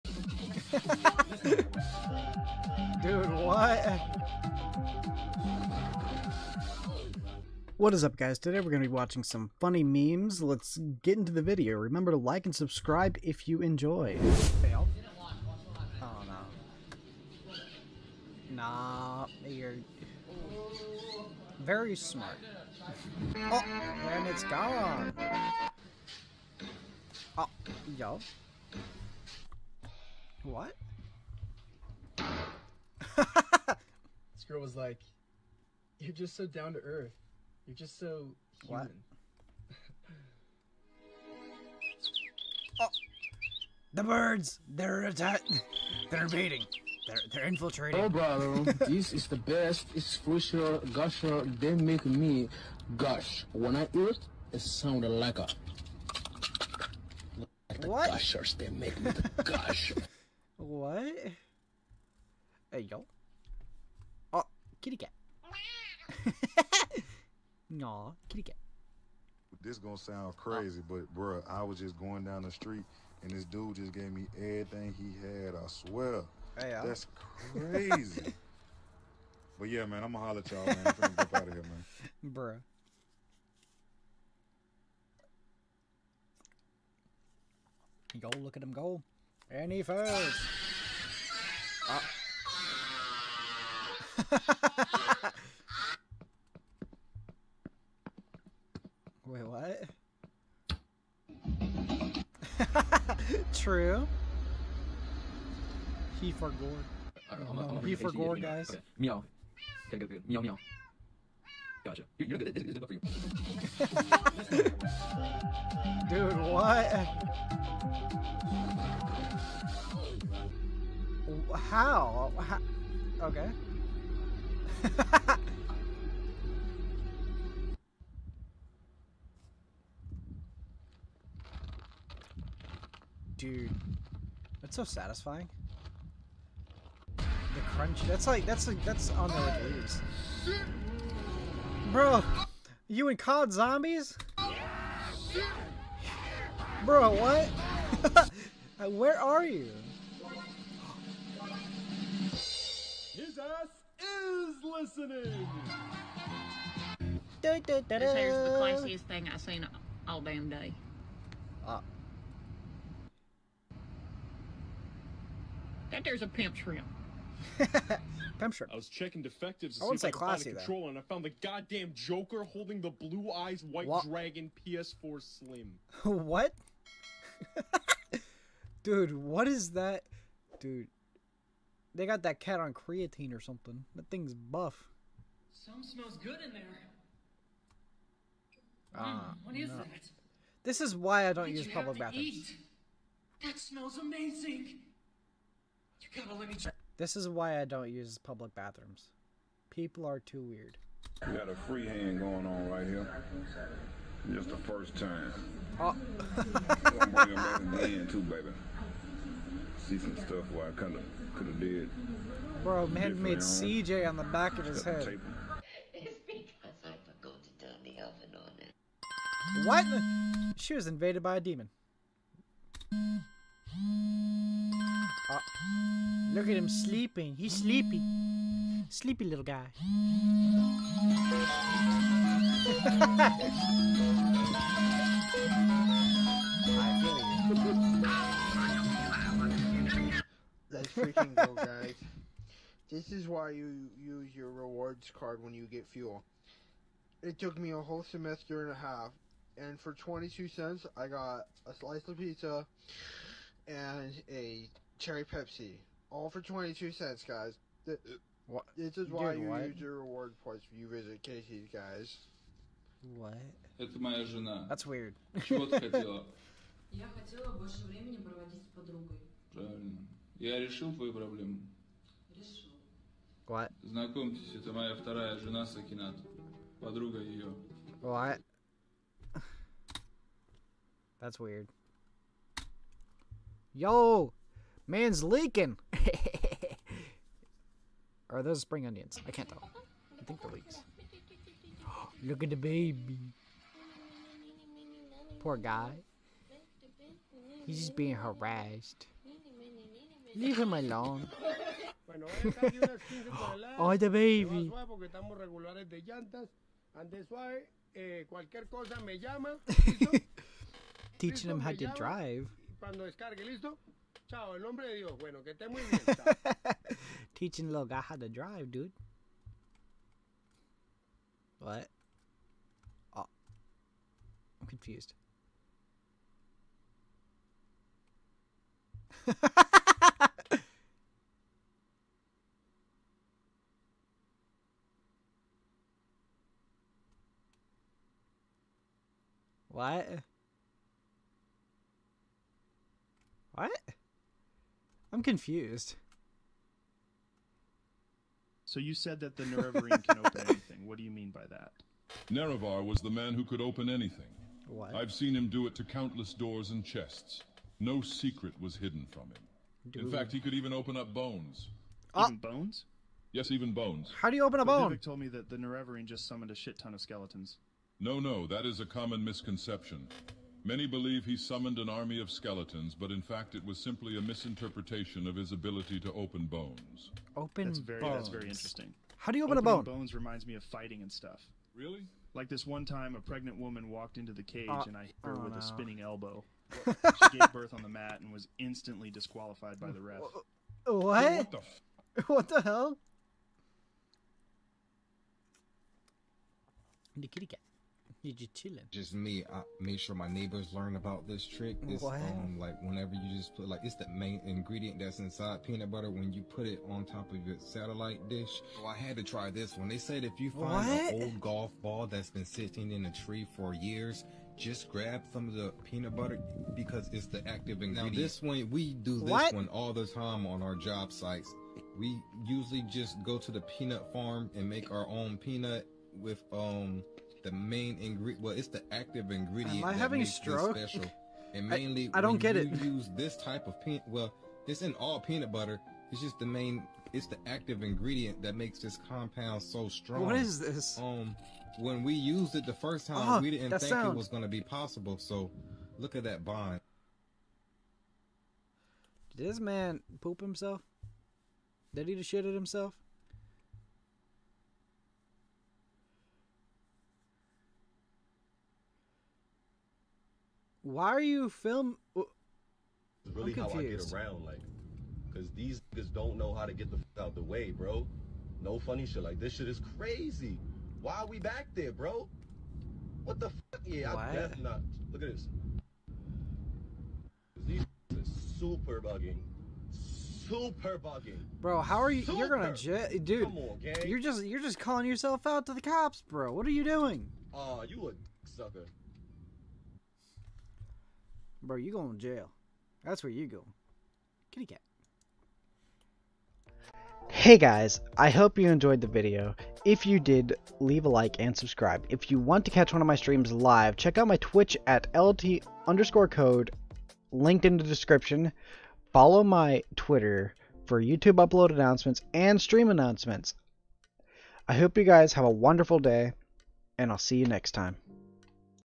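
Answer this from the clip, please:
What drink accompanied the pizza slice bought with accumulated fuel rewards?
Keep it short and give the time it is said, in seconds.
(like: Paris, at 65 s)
cherry Pepsi, at 254 s.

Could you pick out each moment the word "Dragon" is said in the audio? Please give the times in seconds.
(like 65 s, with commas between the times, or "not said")
174 s.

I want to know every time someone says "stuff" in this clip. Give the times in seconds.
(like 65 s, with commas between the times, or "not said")
210 s, 381 s.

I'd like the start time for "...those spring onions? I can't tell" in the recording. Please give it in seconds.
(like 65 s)
288 s.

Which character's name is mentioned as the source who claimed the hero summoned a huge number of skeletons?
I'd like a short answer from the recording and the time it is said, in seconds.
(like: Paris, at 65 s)
Vivec, at 364 s.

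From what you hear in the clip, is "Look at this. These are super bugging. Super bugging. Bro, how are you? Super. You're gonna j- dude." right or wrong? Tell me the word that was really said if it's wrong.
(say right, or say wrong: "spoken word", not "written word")
right.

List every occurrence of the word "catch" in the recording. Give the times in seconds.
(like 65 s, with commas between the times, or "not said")
502 s.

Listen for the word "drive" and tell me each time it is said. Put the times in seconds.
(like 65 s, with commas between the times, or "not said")
311 s, 318 s.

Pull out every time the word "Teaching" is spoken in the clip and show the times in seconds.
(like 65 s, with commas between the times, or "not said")
311 s, 317 s.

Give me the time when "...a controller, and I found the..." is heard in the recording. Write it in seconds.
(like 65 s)
170 s.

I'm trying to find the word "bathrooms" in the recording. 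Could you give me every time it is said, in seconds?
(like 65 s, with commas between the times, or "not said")
191 s, 198 s.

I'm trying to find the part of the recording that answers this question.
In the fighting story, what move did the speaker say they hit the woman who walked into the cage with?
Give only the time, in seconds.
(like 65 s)
385 s.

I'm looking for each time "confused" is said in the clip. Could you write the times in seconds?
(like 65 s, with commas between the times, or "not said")
324 s, 345 s.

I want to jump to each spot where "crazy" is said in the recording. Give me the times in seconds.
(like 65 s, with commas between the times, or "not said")
70 s, 77 s, 469 s.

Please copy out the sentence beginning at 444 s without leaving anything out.
it was going to be possible.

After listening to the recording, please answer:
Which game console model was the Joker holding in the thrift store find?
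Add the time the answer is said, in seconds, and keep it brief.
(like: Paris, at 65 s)
PS4 Slim, at 174 s.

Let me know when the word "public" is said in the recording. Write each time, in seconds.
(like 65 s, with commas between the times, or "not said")
191 s, 198 s.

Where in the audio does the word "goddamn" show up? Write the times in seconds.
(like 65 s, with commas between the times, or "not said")
171 s.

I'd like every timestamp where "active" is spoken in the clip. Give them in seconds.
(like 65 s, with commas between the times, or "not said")
417 s, 428 s, 437 s.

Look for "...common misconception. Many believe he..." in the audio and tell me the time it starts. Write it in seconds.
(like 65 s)
368 s.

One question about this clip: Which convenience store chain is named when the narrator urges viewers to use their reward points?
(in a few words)
Casey's.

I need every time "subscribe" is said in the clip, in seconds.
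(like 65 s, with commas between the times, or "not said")
12 s, 501 s.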